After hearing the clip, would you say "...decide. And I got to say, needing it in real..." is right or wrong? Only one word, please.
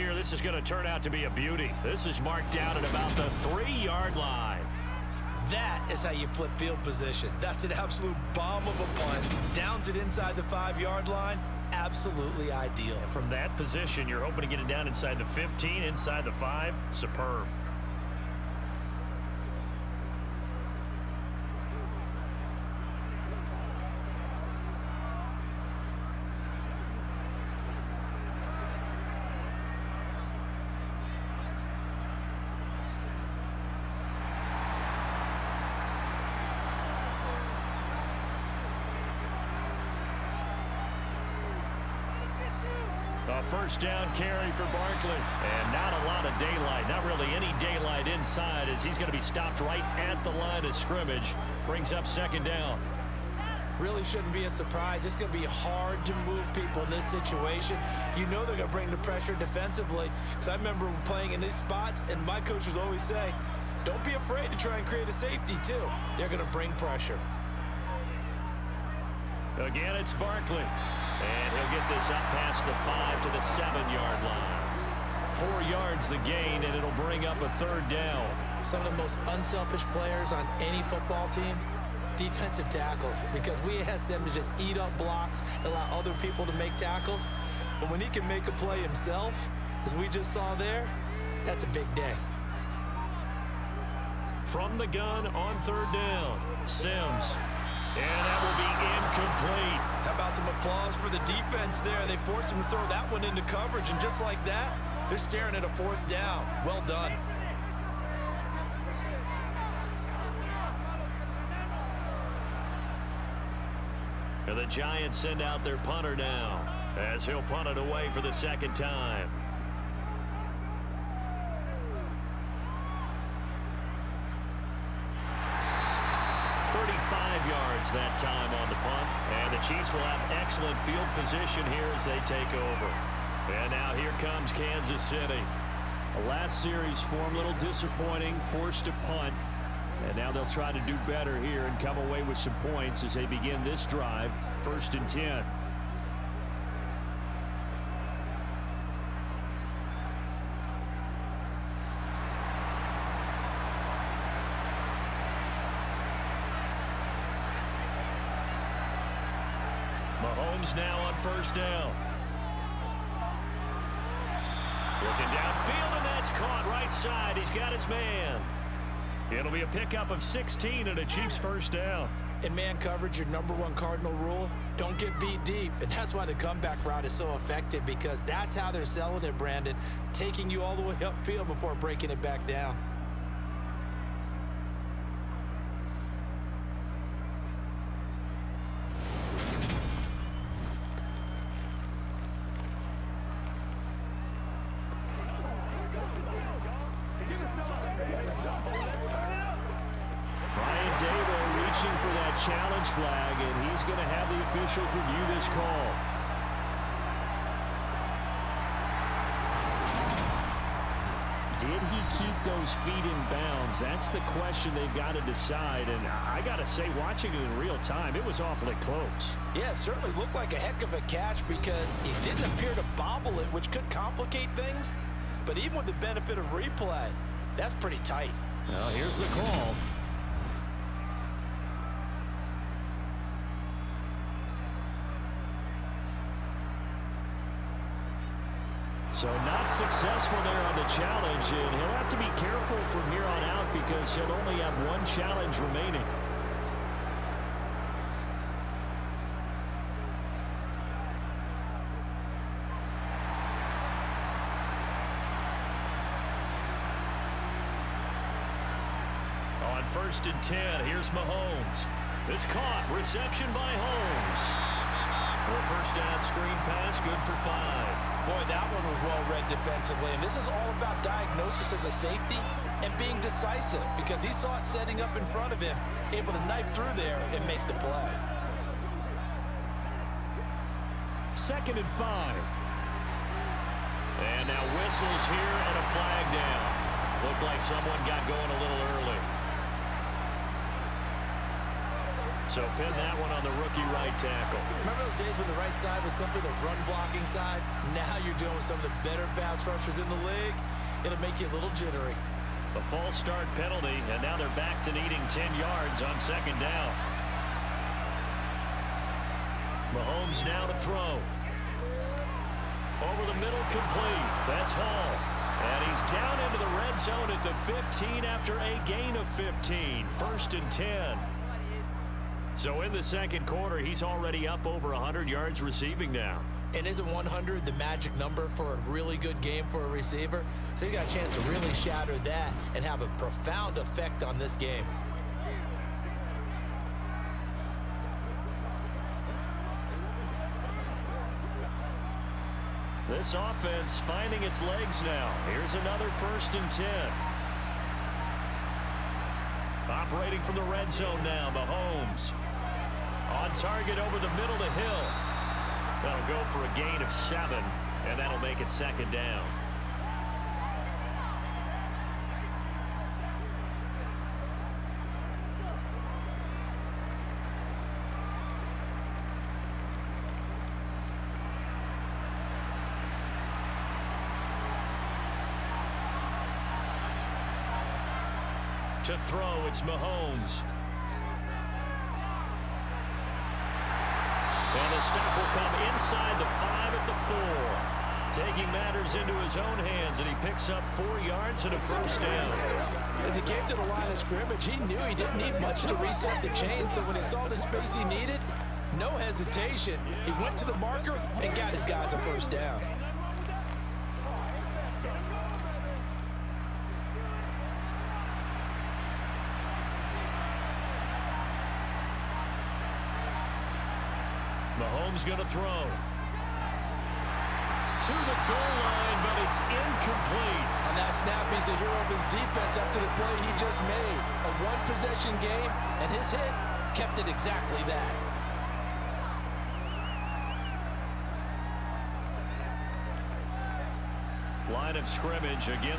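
wrong.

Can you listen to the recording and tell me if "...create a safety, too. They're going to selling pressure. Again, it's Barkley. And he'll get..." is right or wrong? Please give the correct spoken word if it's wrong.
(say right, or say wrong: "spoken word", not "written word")
wrong: "bring", not "selling".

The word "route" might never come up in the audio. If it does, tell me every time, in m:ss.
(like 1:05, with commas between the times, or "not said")
2:56.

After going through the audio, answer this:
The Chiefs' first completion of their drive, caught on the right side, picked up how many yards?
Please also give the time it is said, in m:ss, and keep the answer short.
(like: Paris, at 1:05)
16, at 2:50.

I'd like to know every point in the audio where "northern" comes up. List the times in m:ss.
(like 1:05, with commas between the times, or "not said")
not said.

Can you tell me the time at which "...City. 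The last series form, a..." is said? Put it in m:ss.
2:14.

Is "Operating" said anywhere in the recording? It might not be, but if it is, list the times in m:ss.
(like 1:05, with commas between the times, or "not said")
5:49.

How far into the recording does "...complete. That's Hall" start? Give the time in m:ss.
5:13.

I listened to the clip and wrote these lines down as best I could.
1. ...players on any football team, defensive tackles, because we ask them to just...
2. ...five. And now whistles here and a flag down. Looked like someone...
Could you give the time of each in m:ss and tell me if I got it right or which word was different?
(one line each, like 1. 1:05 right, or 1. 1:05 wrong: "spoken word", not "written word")
1. 1:19 right
2. 4:41 right.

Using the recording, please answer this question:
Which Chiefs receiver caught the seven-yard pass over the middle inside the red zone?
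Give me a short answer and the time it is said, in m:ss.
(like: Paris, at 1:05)
Hill, at 5:54.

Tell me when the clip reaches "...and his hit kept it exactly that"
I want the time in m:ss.
7:05.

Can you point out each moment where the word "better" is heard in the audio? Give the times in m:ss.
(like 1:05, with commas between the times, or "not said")
2:21, 4:59.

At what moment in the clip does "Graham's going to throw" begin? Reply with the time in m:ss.
6:55.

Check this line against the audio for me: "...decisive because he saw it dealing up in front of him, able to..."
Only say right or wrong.
wrong.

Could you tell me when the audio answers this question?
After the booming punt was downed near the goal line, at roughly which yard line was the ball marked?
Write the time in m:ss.
0:03.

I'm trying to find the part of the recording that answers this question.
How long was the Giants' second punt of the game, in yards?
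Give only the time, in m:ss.
2:06.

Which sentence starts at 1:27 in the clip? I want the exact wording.
But when he can make a play himself, as we just saw there, that's a big day.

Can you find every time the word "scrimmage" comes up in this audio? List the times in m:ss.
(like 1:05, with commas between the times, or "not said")
0:50, 6:34, 7:15.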